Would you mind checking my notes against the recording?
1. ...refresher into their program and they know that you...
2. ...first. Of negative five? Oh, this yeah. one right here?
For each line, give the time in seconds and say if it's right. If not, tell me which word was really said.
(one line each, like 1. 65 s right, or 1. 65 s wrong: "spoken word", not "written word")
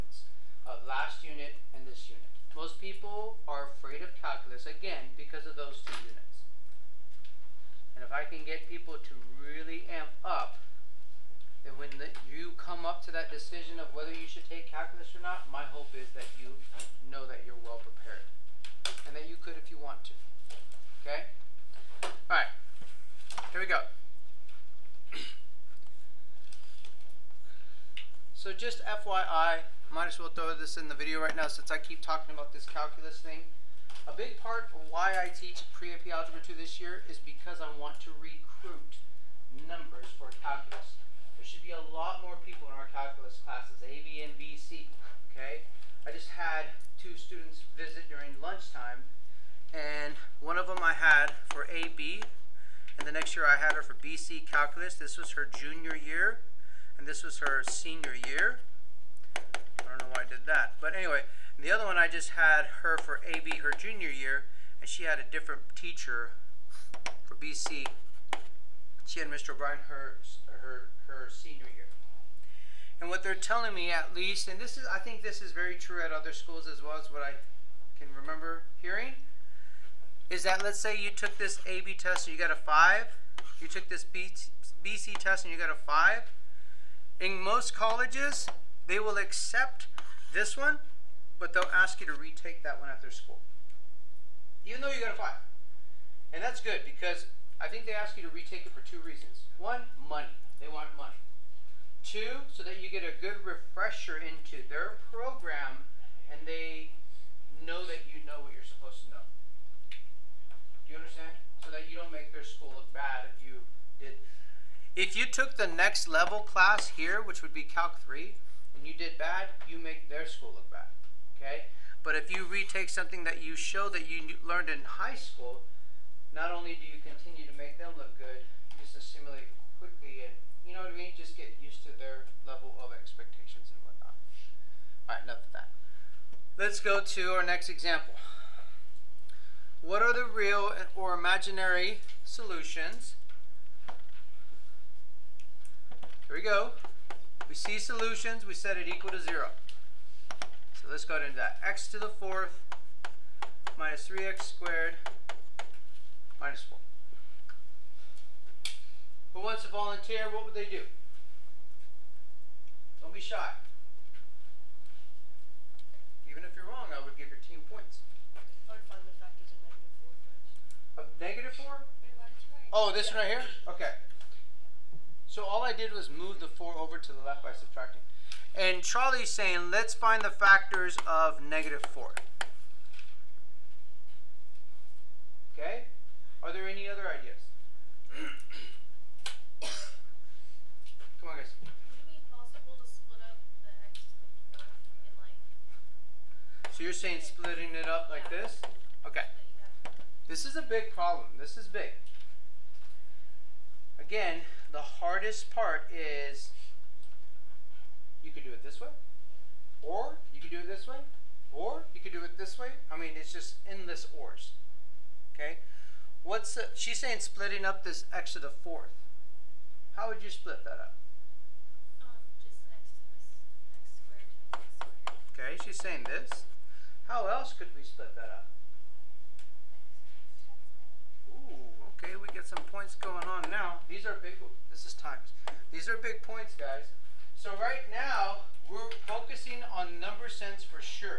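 1. 103 s right
2. 170 s wrong: "four", not "five".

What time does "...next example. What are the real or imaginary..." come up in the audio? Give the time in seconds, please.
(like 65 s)
137 s.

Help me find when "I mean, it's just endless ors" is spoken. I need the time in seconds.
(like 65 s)
212 s.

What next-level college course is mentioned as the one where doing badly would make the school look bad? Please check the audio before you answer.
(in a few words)
Calc 3.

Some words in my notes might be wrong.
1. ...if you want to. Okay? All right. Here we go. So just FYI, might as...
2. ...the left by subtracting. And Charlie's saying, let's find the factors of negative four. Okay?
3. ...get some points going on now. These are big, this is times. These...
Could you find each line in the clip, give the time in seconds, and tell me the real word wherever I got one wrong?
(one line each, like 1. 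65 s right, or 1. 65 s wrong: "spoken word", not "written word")
1. 19 s right
2. 177 s right
3. 232 s right.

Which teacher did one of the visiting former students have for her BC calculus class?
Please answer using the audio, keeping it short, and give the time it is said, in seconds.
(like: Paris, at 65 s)
Mr. O'Brien, at 69 s.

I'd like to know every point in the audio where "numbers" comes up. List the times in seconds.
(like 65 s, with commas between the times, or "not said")
39 s, 239 s.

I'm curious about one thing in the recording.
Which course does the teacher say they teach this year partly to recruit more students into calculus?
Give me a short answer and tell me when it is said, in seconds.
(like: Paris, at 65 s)
Pre-AP Algebra 2, at 35 s.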